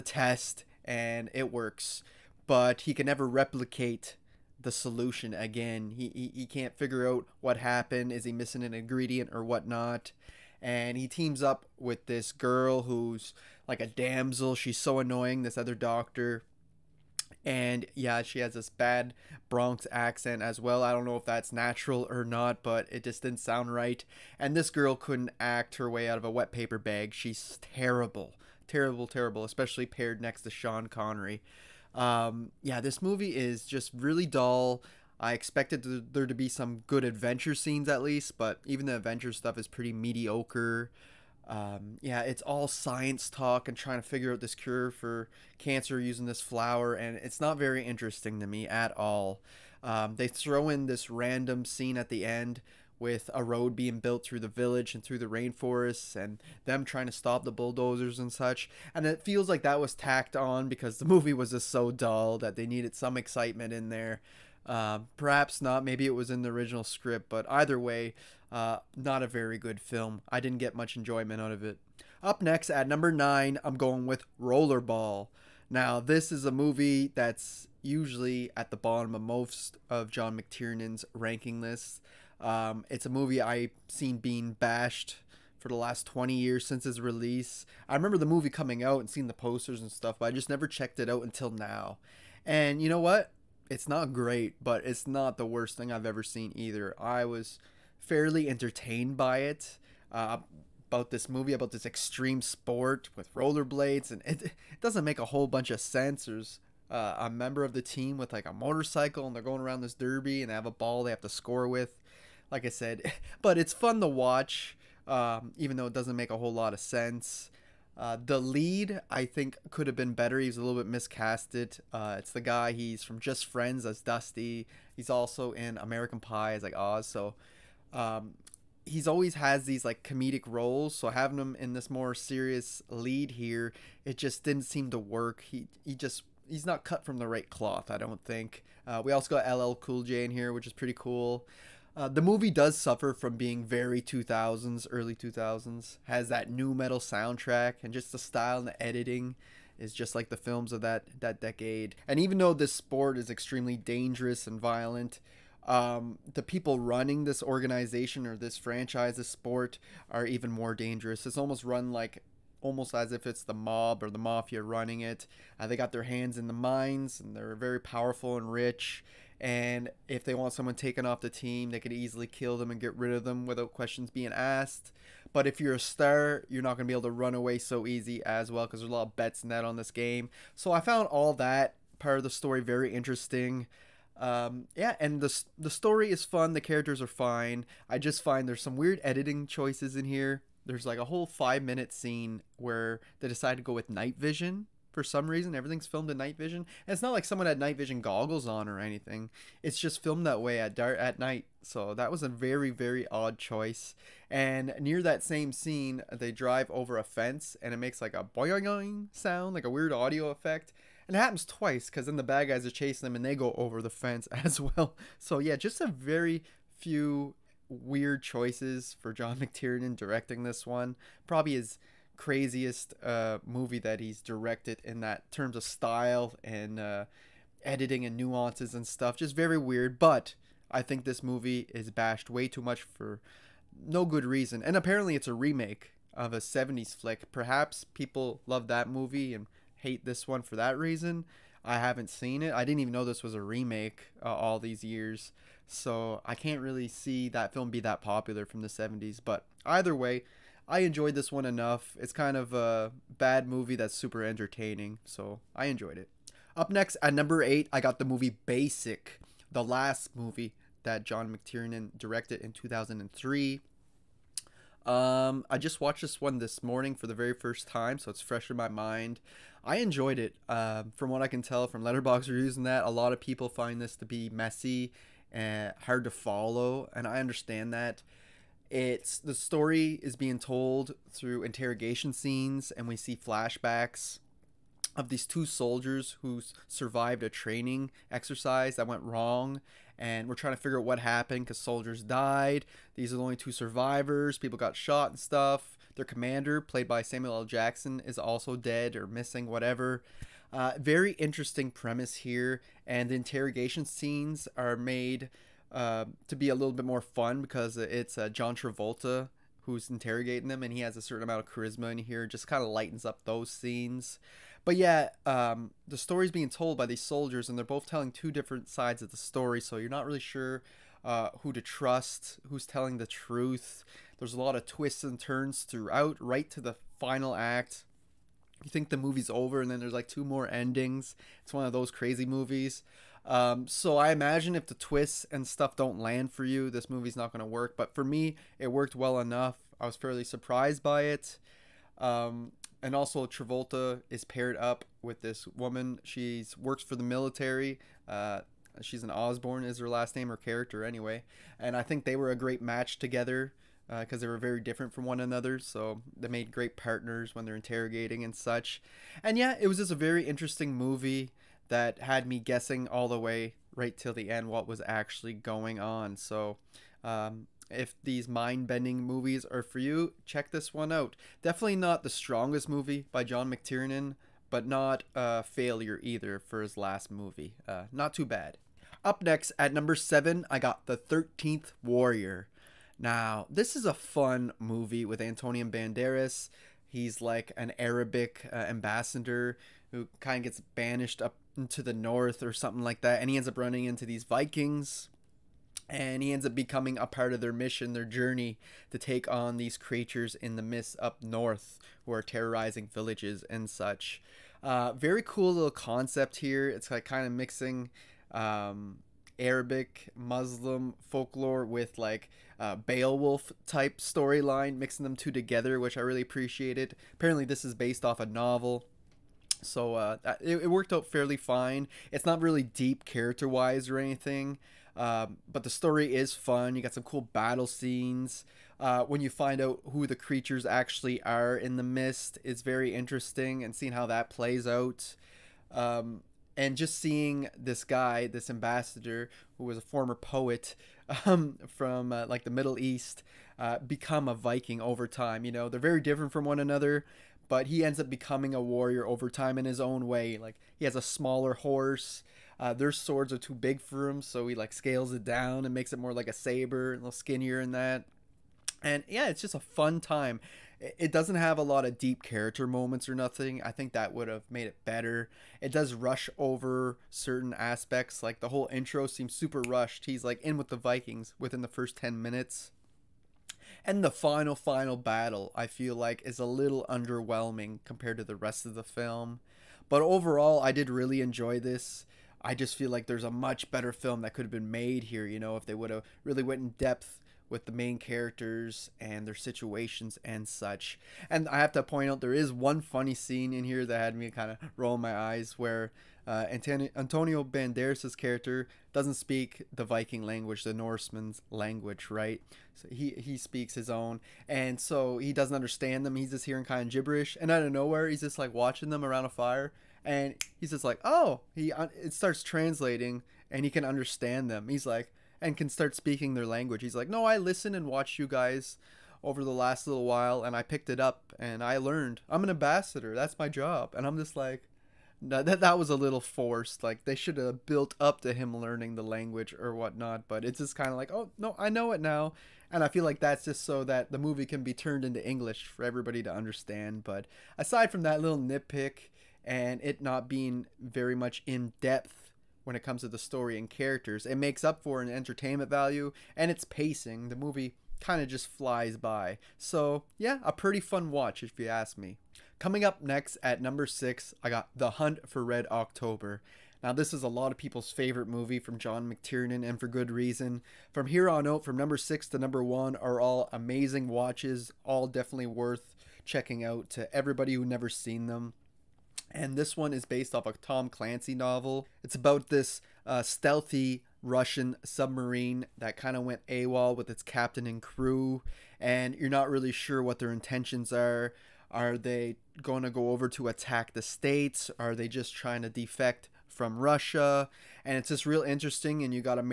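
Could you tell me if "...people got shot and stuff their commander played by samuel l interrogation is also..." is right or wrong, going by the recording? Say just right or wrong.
wrong.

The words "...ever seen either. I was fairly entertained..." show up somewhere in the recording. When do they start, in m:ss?
1:36.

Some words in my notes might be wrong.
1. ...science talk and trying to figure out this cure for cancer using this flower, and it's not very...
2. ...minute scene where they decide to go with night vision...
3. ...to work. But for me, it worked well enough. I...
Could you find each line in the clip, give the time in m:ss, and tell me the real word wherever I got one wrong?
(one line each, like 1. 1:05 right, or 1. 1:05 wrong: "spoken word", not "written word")
1. 0:42 right
2. 3:11 right
3. 5:37 right.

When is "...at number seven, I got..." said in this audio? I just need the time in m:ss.
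6:19.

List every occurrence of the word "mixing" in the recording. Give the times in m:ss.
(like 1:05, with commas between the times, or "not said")
6:47, 6:54.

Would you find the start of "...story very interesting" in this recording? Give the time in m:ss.
3:02.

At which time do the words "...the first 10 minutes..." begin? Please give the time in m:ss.
7:51.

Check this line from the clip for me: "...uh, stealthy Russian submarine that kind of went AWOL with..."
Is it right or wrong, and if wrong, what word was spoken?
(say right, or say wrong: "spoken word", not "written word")
right.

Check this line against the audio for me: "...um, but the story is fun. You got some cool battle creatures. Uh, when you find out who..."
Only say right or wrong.
wrong.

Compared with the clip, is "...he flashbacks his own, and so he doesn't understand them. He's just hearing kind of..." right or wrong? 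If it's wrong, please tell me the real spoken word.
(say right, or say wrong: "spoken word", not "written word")
wrong: "speaks", not "flashbacks".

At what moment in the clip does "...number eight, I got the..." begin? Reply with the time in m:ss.
4:17.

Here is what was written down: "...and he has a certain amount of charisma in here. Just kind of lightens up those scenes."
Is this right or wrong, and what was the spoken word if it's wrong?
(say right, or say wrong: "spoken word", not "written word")
right.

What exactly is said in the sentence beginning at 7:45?
It does rush over certain aspects.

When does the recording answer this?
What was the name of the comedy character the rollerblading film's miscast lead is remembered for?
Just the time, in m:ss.
2:04.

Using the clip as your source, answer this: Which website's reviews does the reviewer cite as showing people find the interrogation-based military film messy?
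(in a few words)
Letterboxd.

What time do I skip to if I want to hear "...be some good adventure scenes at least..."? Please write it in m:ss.
0:36.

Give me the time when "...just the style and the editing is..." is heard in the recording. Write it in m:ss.
2:27.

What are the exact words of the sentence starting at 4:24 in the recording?
Um, I just watched this one this morning for the very first time, so it's fresh in my mind.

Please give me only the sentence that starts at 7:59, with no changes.
But overall, I did really enjoy this.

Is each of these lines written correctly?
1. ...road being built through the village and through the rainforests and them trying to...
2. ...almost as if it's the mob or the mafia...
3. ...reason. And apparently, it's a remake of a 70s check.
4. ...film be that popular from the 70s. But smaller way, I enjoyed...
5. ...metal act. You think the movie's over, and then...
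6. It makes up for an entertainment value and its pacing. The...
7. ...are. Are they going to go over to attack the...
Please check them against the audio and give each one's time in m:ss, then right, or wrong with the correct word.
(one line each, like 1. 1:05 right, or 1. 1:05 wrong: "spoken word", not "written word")
1. 0:53 right
2. 2:42 right
3. 3:54 wrong: "flick", not "check"
4. 4:07 wrong: "either", not "smaller"
5. 5:26 wrong: "final", not "metal"
6. 9:04 right
7. 9:40 right.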